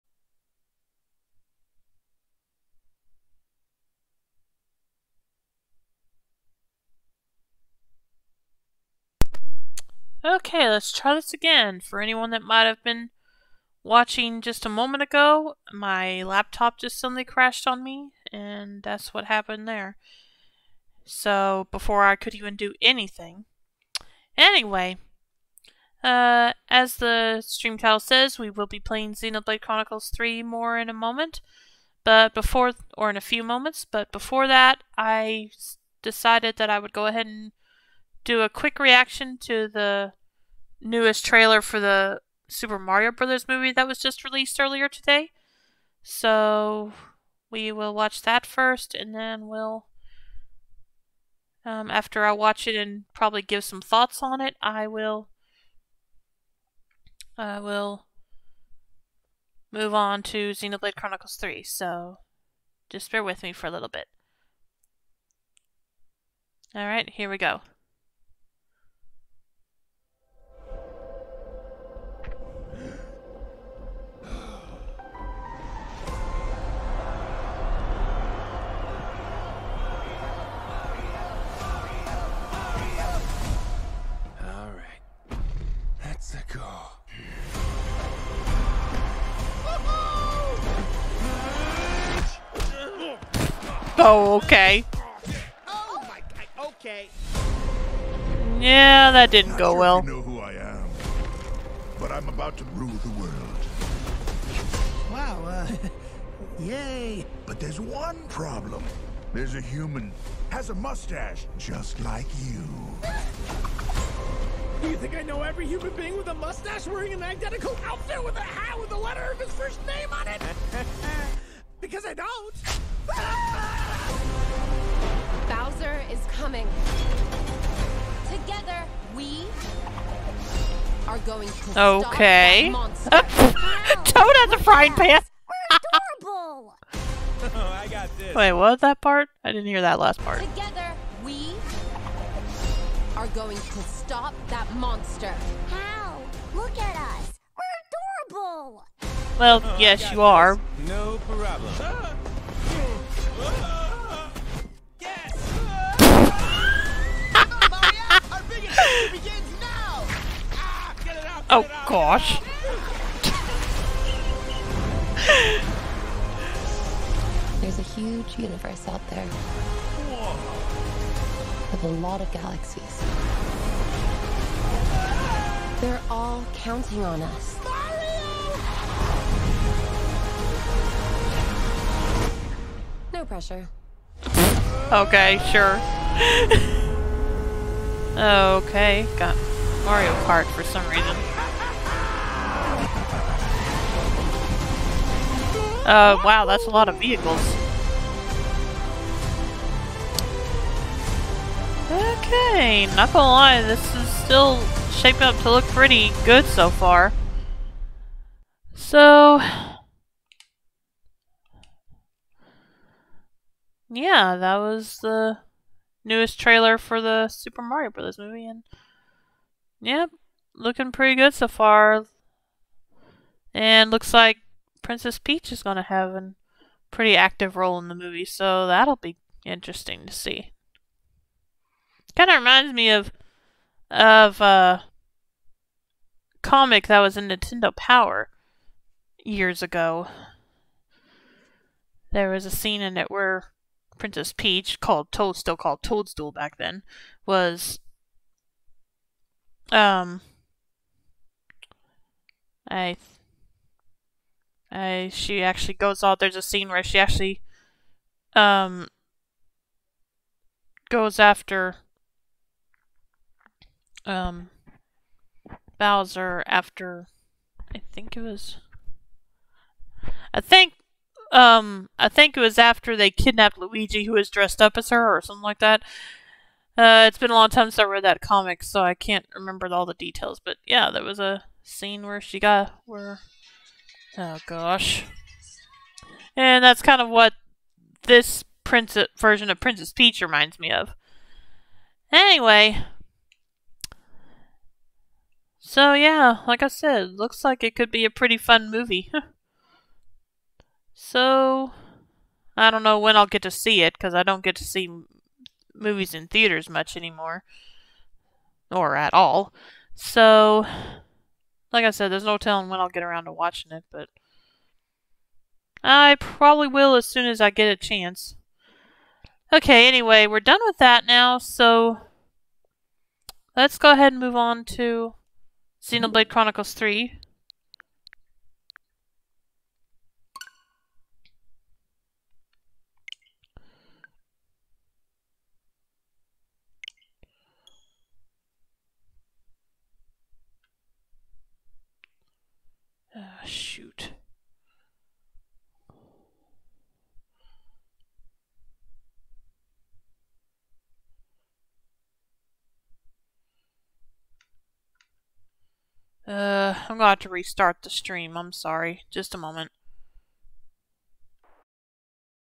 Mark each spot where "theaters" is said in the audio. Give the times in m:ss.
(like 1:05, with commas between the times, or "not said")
5:06.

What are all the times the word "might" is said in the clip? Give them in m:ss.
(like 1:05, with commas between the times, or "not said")
0:12.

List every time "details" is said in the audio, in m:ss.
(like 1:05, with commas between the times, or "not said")
4:39.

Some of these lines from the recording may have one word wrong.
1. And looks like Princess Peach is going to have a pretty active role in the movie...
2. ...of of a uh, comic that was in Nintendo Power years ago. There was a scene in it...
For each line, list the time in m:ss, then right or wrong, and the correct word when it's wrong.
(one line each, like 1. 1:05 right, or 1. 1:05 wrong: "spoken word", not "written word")
1. 3:43 right
2. 3:52 right.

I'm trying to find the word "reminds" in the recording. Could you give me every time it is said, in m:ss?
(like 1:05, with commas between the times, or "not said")
3:52, 4:50.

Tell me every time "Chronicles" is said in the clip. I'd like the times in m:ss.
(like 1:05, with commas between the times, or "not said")
0:29, 1:00, 5:26.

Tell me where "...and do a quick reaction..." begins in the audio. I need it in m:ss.
0:37.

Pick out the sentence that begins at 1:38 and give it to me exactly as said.
Yeah, that didn't Not go sure well.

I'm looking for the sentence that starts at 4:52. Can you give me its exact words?
Anyway, so yeah, like I said, looks like it could be a pretty fun movie.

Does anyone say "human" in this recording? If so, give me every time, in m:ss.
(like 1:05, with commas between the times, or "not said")
1:49, 1:55.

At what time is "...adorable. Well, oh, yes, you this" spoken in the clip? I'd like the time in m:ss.
2:28.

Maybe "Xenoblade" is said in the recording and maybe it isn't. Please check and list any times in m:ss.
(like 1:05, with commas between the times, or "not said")
0:29, 1:00, 5:25.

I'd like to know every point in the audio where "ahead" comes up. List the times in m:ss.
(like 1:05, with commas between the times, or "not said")
0:37, 5:23.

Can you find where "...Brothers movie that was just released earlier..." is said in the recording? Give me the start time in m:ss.
0:43.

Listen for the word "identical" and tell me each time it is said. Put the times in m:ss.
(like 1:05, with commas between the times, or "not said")
1:57.